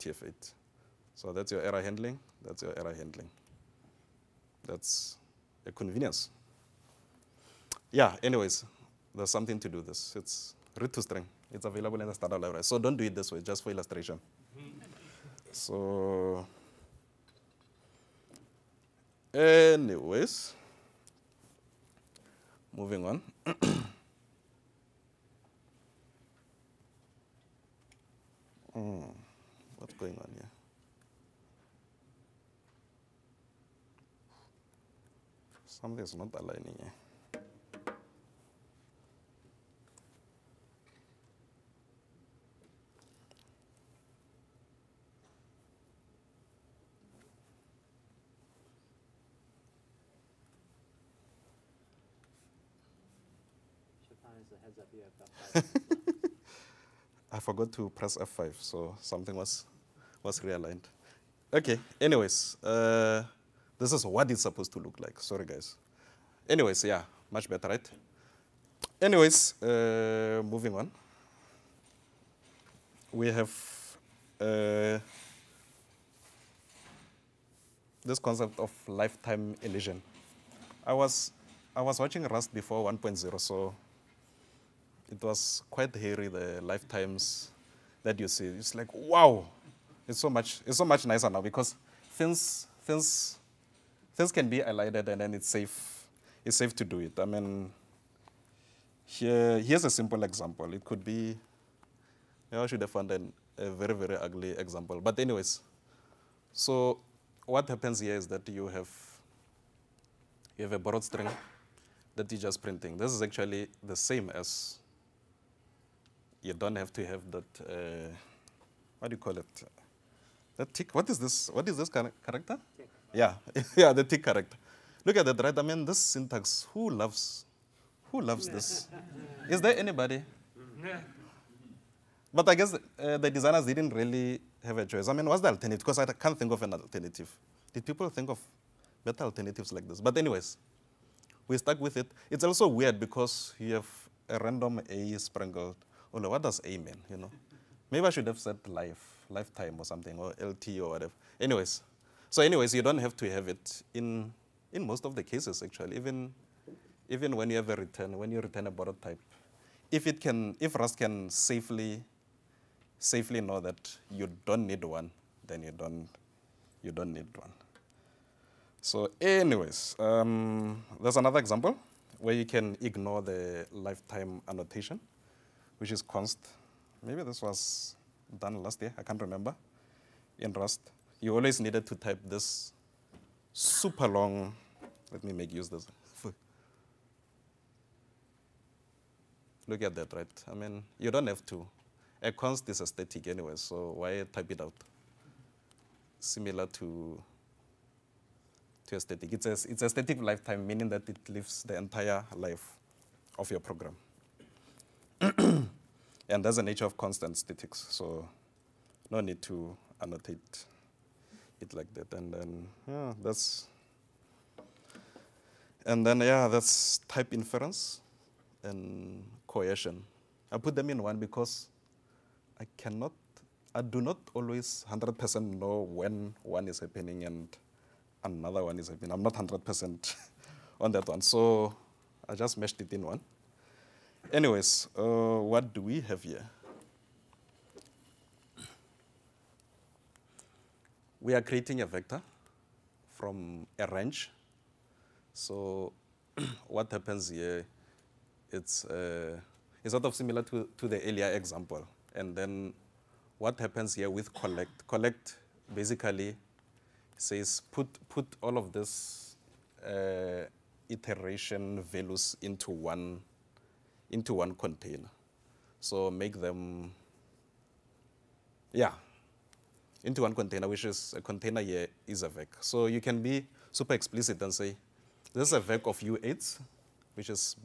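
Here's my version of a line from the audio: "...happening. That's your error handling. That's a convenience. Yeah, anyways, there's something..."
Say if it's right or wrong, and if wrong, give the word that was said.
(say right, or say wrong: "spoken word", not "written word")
wrong: "handling", not "happening".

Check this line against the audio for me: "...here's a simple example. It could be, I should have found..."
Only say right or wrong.
right.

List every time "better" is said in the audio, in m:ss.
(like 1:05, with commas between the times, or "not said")
1:07, 2:19.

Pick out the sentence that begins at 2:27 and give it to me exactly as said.
You know, maybe I should have said life, lifetime or something, or LT or whatever.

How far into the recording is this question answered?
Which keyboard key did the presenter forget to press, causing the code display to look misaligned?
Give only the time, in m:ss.
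0:58.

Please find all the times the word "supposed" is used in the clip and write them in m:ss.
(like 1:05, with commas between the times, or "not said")
1:04.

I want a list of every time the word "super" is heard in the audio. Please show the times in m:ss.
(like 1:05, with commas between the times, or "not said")
3:03, 4:33.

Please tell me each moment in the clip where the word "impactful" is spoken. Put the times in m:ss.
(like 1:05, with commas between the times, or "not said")
not said.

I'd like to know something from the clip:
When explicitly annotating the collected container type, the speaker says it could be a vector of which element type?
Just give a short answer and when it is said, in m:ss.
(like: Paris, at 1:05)
u8, at 4:35.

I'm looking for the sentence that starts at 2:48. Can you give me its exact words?
So anyways, um, there's another example where you can ignore the lifetime annotation which is const.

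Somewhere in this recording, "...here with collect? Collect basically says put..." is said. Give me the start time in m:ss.
4:13.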